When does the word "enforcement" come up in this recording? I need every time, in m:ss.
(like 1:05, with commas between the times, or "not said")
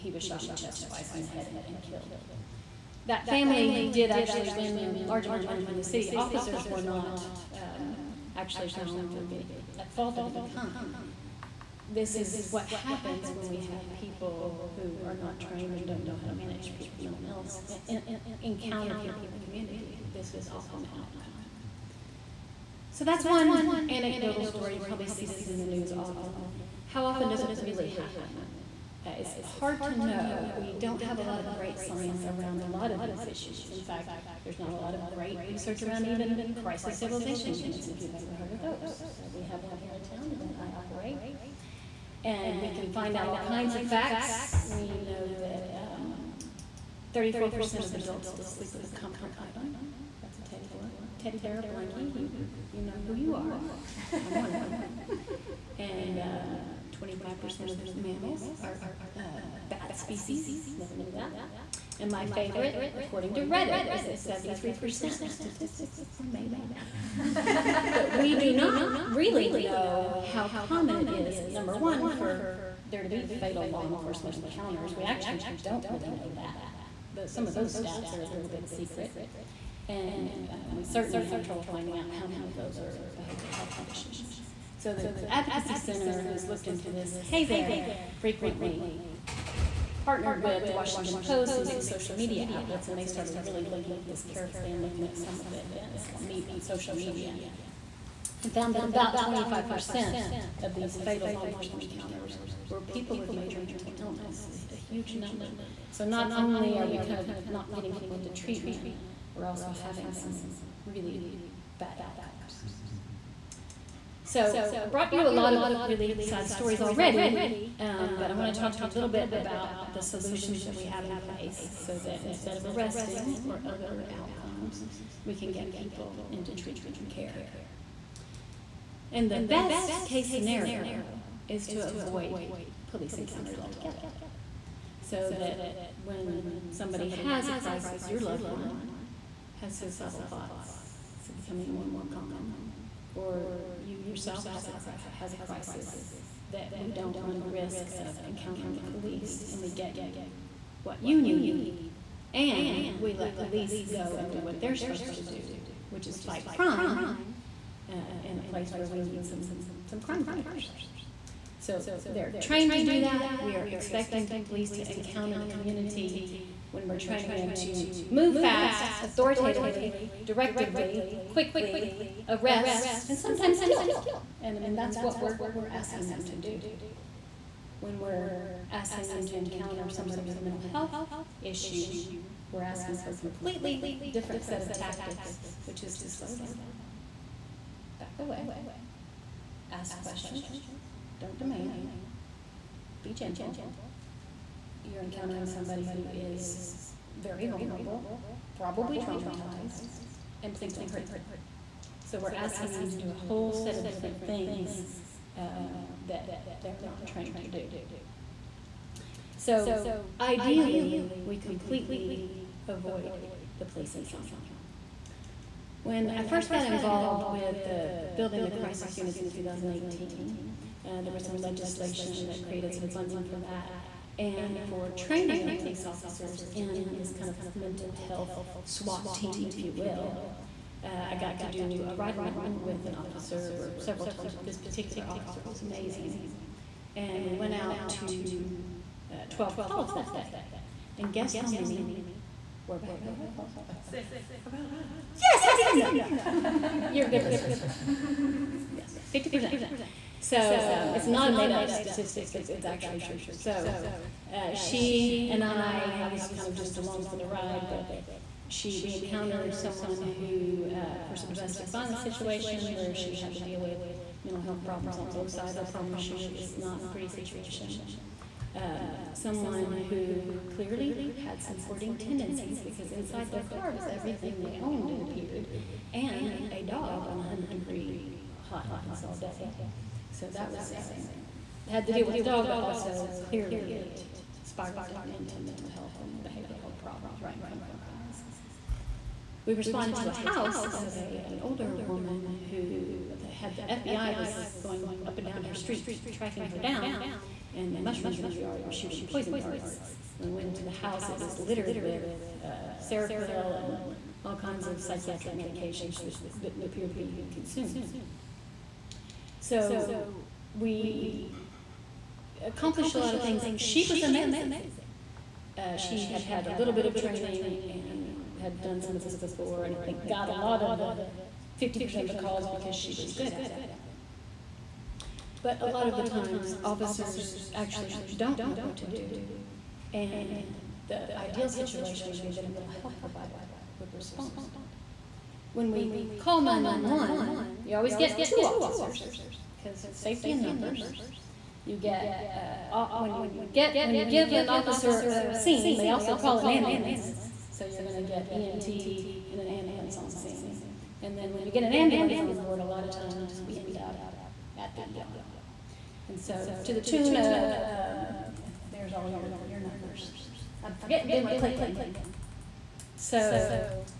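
1:13, 1:41.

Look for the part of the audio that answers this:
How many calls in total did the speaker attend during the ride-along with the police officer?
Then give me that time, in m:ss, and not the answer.
3:59.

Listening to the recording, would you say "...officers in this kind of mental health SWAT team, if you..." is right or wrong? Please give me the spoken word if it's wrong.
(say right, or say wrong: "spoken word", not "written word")
right.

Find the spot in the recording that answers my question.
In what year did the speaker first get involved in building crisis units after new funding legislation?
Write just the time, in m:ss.
3:39.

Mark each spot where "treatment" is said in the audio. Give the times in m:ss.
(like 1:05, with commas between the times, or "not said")
1:48, 2:06.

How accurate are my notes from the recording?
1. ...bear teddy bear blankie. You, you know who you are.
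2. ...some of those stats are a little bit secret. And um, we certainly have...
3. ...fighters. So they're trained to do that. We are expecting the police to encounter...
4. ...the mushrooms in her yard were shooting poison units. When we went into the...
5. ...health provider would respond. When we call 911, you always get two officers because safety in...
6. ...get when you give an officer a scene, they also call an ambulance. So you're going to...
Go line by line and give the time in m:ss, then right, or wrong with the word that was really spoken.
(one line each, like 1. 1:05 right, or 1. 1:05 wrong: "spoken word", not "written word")
1. 0:50 right
2. 1:17 right
3. 2:40 right
4. 4:57 wrong: "darts", not "units"
5. 5:32 right
6. 5:43 right.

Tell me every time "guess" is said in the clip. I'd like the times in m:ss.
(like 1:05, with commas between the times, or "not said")
4:01.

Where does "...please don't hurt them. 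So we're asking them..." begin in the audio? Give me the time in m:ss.
3:20.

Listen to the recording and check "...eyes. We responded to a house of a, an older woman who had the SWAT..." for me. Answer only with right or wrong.
wrong.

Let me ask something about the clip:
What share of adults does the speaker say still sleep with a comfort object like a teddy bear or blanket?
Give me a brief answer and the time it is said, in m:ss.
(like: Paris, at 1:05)
34%, at 0:47.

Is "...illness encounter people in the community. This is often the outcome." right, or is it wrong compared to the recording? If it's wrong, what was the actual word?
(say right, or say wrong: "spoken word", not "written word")
right.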